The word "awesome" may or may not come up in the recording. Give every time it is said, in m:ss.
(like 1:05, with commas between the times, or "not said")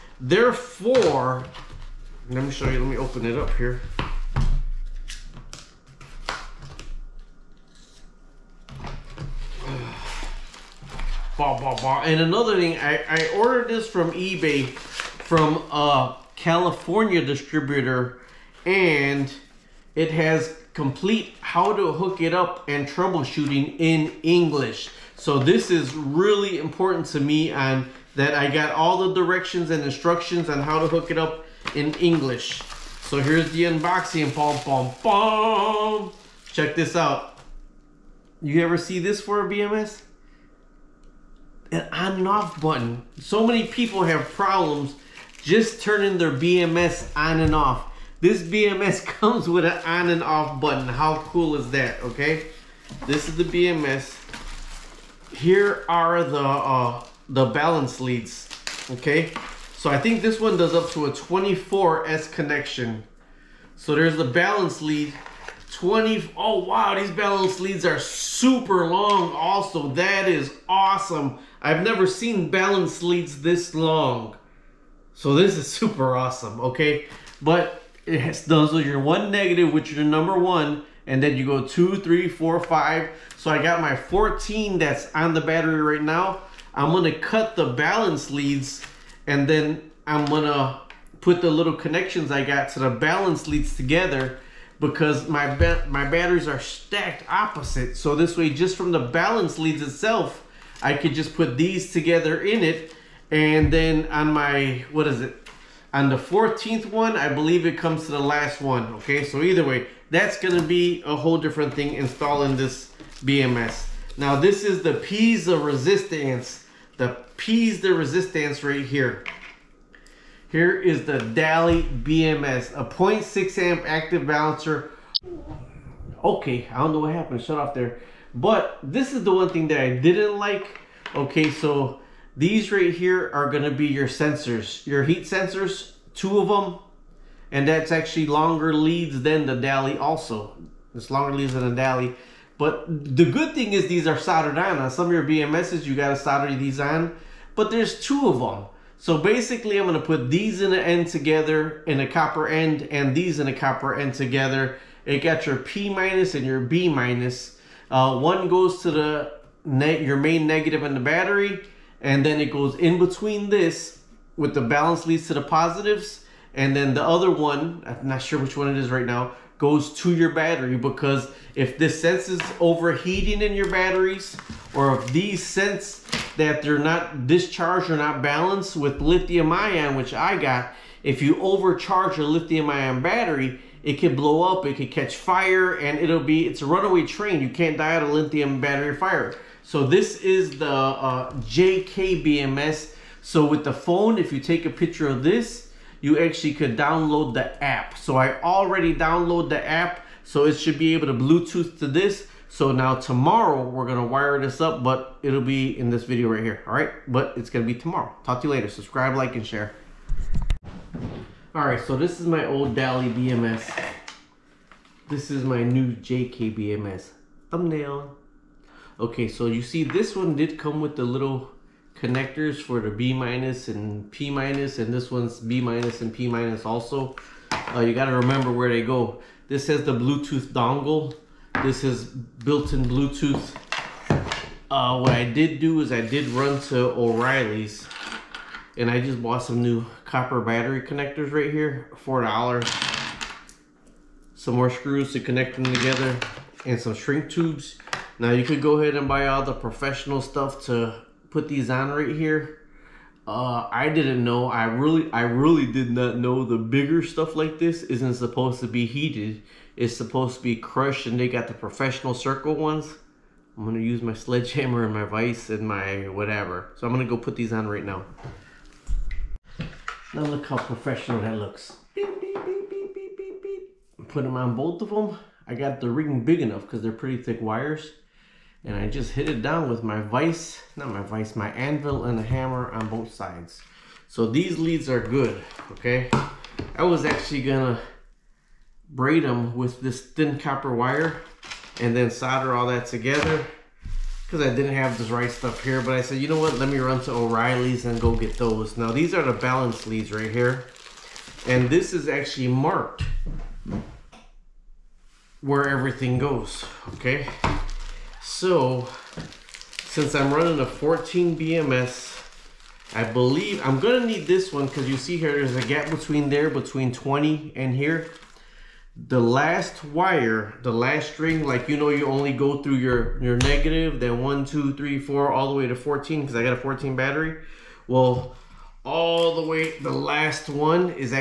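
1:10, 1:16.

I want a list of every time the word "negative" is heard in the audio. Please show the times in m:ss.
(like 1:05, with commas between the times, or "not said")
1:19, 2:40, 5:23.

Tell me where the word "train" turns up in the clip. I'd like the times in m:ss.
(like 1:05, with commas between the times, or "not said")
3:07.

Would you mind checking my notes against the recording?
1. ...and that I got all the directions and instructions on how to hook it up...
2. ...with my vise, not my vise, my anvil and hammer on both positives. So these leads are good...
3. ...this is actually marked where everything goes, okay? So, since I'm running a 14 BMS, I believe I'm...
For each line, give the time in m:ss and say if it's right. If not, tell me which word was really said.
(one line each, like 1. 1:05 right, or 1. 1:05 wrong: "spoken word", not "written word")
1. 0:27 right
2. 4:39 wrong: "sides", not "positives"
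3. 5:01 right.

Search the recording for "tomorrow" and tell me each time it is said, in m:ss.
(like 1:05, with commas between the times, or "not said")
3:22, 3:27.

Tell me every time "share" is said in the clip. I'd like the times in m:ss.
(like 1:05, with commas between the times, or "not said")
3:29.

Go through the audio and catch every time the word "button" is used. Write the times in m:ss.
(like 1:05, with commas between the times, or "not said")
0:42, 0:50.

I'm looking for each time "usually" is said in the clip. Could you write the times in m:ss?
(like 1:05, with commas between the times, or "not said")
not said.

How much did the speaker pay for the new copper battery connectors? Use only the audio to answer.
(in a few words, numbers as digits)
$4.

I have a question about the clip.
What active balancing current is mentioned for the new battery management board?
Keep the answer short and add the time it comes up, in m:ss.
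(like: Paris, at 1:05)
0.6 amp, at 2:02.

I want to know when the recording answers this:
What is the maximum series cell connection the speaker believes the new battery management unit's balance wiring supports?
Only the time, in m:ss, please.
1:01.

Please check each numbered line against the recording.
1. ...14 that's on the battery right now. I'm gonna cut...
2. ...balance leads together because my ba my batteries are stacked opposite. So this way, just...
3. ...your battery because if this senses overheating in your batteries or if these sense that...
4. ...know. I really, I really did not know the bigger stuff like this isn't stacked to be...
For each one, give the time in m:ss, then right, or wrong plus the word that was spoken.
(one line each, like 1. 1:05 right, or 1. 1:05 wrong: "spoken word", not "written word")
1. 1:23 right
2. 1:32 right
3. 2:50 right
4. 4:14 wrong: "supposed", not "stacked".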